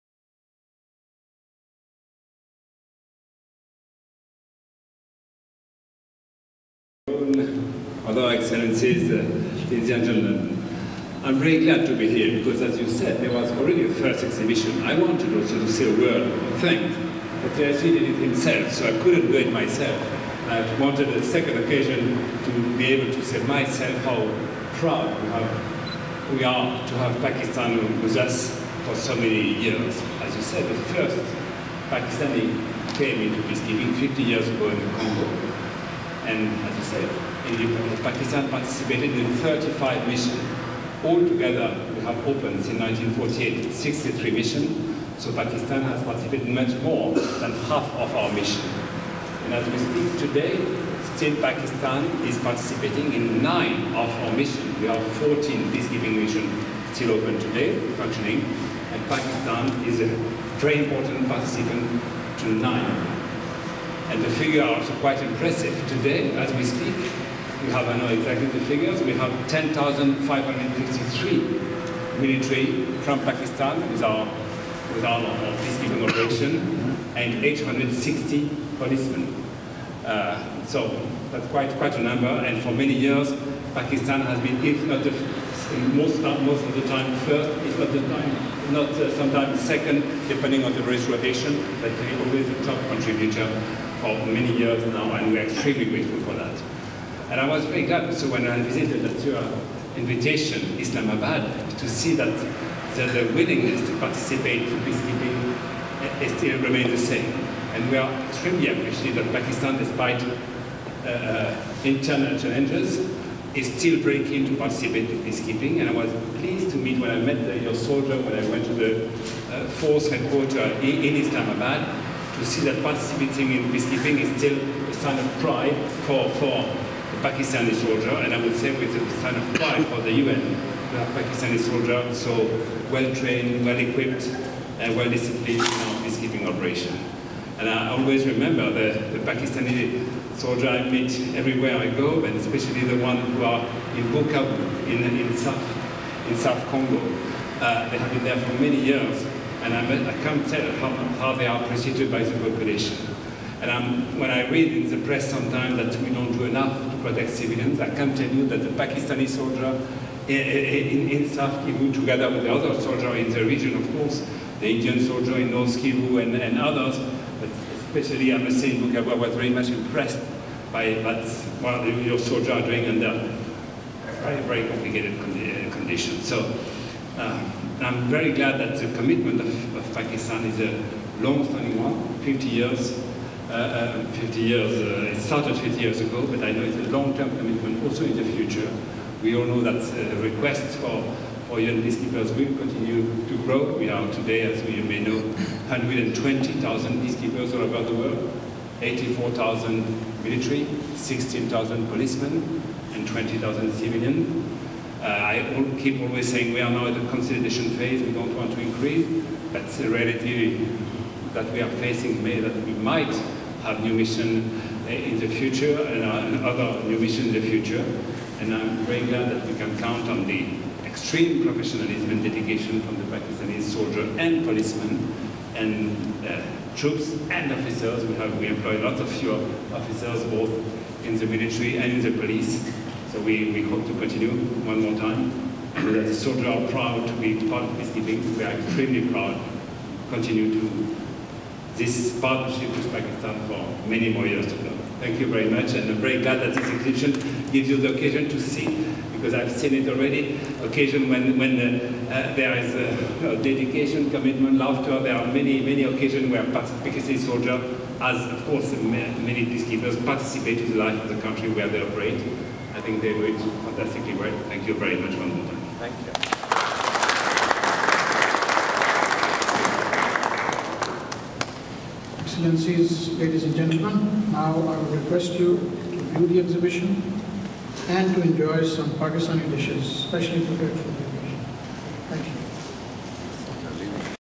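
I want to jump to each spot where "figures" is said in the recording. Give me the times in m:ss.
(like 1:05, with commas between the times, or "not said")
1:04, 1:08.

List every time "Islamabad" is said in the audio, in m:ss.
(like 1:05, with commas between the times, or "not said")
1:40, 2:01.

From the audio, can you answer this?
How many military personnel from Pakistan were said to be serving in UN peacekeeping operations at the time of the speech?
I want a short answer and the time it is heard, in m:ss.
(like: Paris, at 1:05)
10,553, at 1:09.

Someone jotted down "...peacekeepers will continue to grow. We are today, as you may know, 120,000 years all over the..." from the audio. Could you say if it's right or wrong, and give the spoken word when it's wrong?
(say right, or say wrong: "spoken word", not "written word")
wrong: "peacekeepers", not "years".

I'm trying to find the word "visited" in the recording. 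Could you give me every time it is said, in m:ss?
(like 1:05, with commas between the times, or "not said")
1:38.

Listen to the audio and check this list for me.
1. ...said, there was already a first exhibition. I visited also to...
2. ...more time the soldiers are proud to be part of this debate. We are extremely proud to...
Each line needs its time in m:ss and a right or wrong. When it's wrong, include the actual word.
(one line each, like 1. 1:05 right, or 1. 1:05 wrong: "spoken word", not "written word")
1. 0:12 wrong: "wanted", not "visited"
2. 3:54 right.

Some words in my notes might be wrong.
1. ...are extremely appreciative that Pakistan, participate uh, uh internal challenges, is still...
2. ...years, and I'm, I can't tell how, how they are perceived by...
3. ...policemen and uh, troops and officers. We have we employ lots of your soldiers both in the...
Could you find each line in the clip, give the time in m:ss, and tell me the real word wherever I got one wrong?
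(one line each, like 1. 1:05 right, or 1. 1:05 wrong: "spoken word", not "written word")
1. 1:47 wrong: "despite", not "participate"
2. 2:28 right
3. 3:44 wrong: "officers", not "soldiers".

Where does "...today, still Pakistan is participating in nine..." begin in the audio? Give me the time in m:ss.
0:50.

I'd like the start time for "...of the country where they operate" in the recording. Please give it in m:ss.
4:21.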